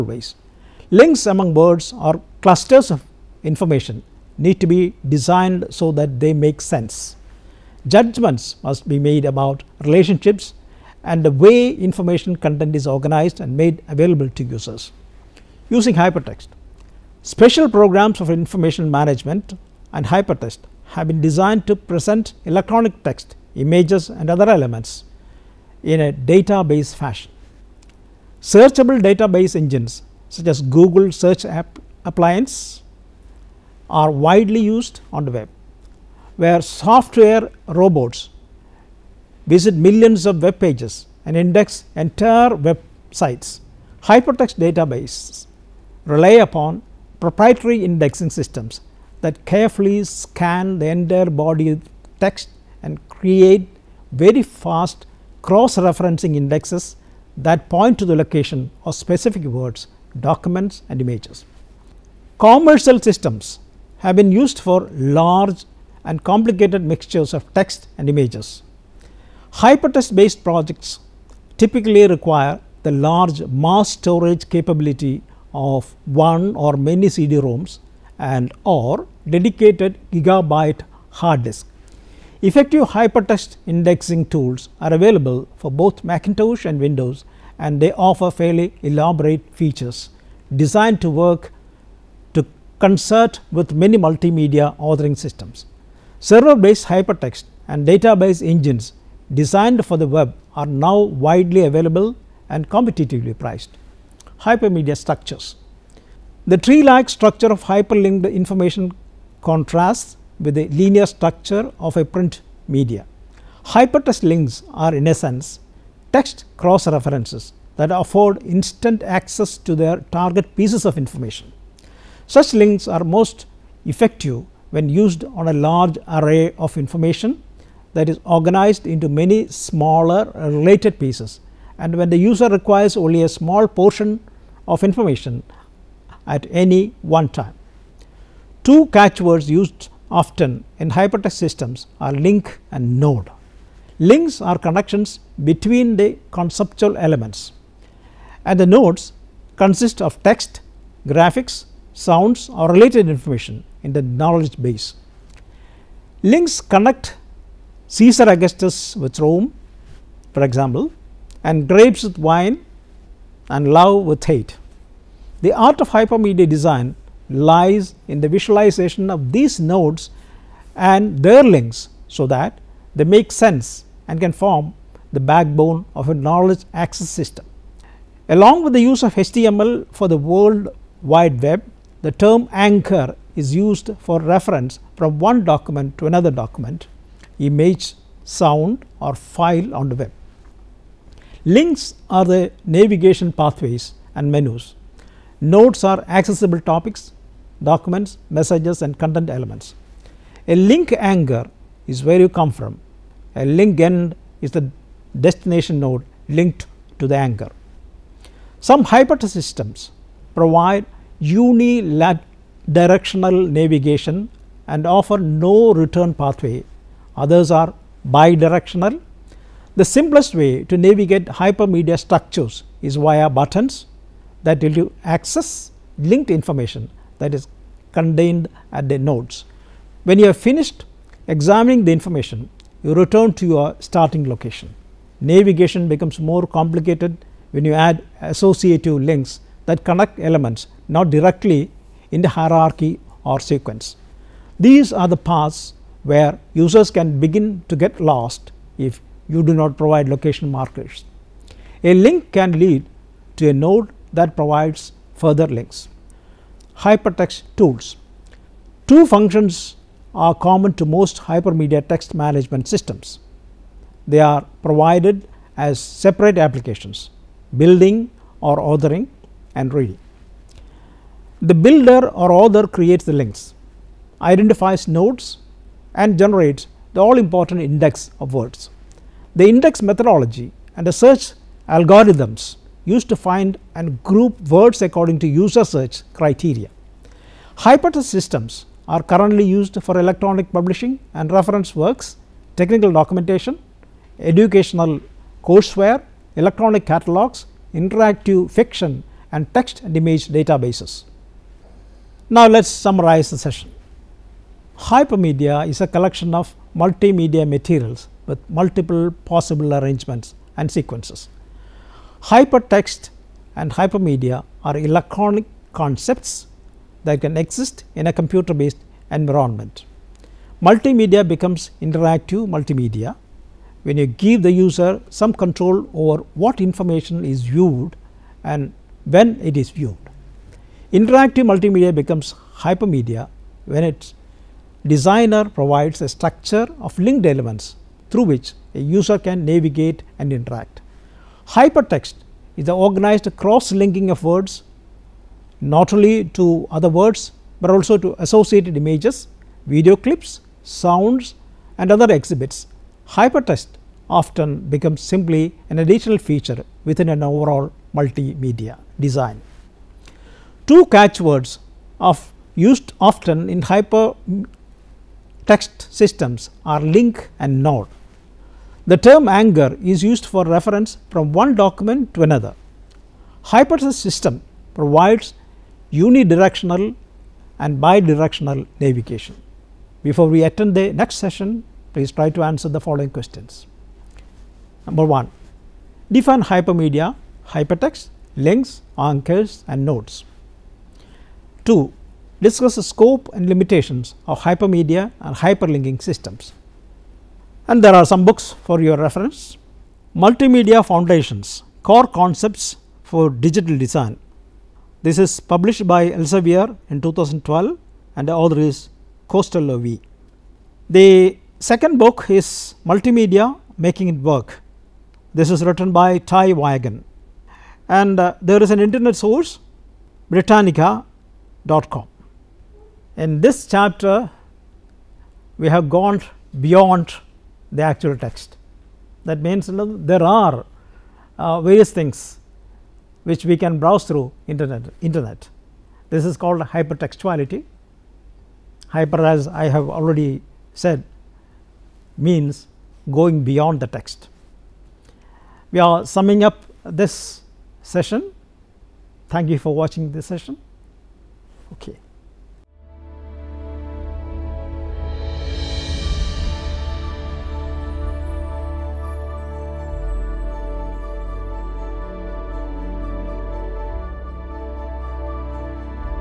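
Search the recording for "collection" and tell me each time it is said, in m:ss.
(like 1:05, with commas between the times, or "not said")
5:05.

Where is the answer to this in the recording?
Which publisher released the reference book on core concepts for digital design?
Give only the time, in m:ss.
6:46.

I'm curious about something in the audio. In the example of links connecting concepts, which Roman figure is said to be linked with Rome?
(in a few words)
Caesar Augustus.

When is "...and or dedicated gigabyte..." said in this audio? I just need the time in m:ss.
1:18.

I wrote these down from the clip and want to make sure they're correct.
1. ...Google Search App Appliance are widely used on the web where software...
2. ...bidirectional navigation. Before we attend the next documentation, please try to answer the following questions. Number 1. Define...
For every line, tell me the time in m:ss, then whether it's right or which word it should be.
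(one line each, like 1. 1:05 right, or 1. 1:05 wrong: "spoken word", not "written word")
1. 0:30 right
2. 6:17 wrong: "session", not "documentation".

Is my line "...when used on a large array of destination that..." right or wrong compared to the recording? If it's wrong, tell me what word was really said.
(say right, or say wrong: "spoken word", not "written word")
wrong: "information", not "destination".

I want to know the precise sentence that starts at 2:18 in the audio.
Two catchwords used often in hypertext systems are link and node.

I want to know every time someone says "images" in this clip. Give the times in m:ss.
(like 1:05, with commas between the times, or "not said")
0:23, 1:00, 1:08, 3:07, 4:59, 5:48.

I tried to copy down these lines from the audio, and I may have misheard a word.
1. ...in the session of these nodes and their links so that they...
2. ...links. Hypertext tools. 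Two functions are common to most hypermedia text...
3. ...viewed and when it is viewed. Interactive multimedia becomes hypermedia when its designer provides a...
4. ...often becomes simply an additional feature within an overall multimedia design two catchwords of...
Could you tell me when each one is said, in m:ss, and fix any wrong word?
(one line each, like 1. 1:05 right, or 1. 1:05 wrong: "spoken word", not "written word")
1. 2:48 wrong: "visualization", not "session"
2. 4:15 right
3. 5:27 right
4. 5:54 right.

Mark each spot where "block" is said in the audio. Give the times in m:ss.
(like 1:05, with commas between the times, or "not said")
not said.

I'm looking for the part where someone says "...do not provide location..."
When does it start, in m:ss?
4:09.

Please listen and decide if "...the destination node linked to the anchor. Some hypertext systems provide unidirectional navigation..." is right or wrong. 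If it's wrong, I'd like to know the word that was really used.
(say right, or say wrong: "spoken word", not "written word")
right.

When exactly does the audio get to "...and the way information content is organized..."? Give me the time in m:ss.
0:11.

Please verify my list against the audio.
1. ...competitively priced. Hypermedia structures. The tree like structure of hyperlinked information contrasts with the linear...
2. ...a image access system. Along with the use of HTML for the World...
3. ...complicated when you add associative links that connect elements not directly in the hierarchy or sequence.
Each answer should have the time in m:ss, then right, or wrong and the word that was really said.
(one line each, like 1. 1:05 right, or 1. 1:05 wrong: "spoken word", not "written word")
1. 1:42 right
2. 2:56 wrong: "knowledge", not "image"
3. 3:56 right.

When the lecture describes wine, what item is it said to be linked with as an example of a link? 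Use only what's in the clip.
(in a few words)
grapes.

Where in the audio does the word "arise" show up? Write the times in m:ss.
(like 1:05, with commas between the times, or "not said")
not said.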